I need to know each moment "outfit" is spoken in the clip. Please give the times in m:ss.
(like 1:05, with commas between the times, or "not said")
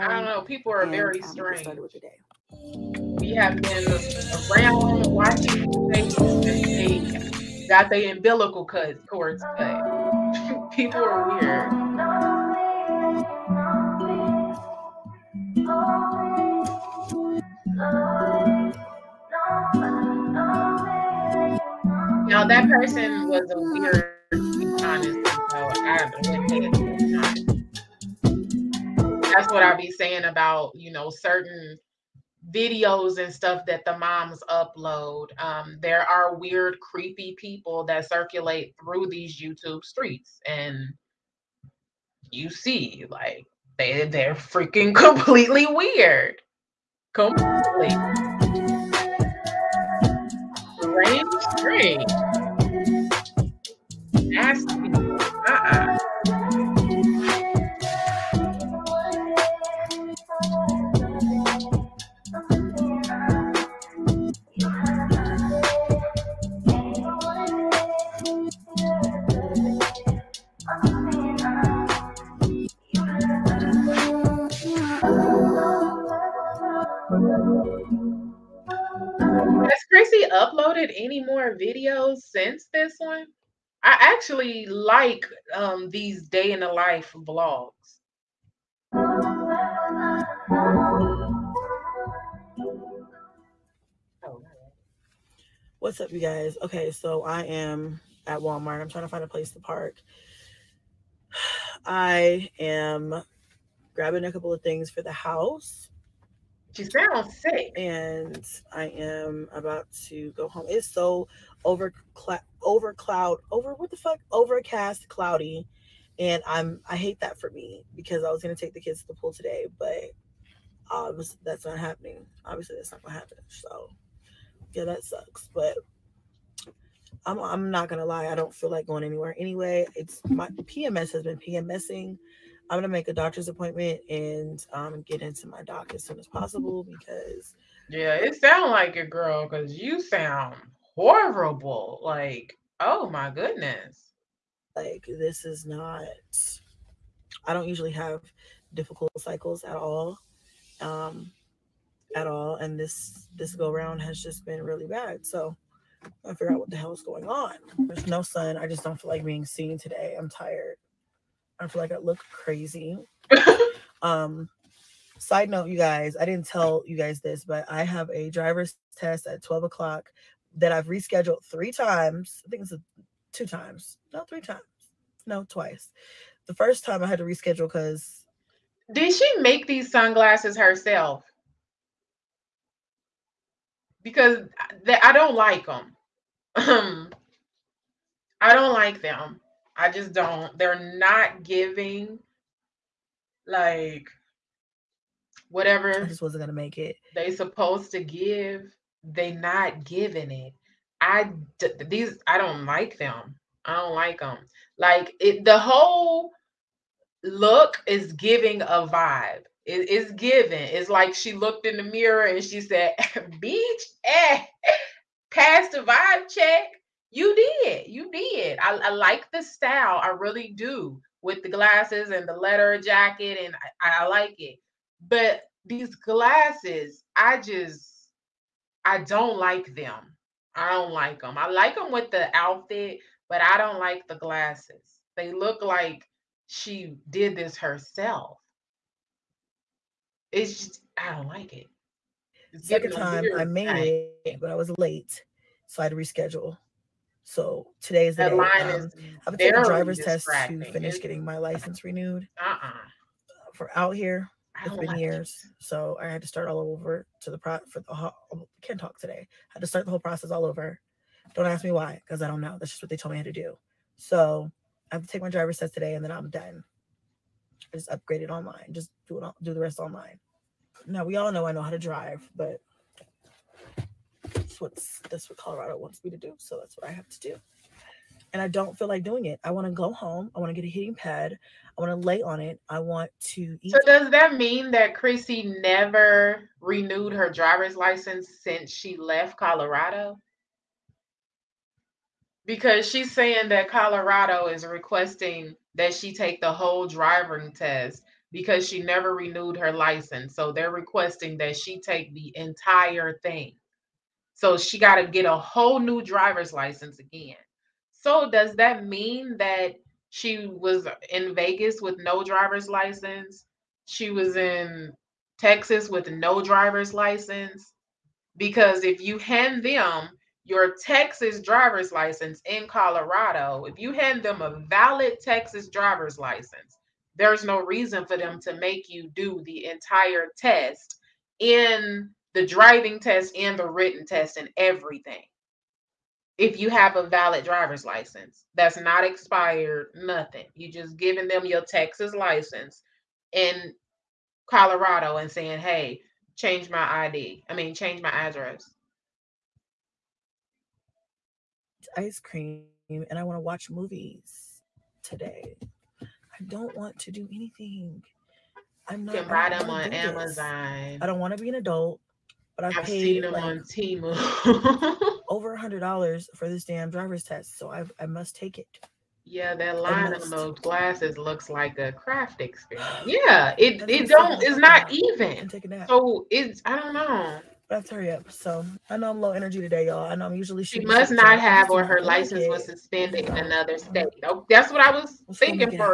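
3:52.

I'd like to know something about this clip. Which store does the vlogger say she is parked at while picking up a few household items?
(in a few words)
Walmart.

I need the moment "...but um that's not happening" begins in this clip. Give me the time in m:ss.
1:59.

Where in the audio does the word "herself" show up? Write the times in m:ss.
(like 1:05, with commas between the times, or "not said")
3:00, 3:57.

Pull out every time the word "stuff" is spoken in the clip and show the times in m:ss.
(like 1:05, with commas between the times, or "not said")
0:33.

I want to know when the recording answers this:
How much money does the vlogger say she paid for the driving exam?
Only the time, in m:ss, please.
6:05.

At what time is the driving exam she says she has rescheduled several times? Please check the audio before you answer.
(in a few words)
12 o'clock.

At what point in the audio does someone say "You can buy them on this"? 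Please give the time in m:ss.
5:59.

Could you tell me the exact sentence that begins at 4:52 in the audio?
Because she's saying that Colorado is requesting that she take the whole driving test because she never renewed her license.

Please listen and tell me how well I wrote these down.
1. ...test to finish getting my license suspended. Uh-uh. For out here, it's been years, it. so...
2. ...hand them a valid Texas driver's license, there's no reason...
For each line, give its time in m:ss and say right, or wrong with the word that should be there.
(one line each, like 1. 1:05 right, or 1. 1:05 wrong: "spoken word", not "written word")
1. 4:09 wrong: "renewed", not "suspended"
2. 5:23 right.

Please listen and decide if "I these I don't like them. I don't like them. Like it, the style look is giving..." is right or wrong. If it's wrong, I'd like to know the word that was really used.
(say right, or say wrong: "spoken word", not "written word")
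wrong: "whole", not "style".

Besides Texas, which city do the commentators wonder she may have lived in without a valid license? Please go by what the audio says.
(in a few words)
Vegas.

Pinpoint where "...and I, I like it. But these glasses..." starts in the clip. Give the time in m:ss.
3:43.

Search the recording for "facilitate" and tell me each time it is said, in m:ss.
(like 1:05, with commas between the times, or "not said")
not said.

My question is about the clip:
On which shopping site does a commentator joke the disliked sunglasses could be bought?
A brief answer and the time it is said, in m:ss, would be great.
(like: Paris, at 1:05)
Temu, at 6:03.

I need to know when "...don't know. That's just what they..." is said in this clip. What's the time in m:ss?
4:22.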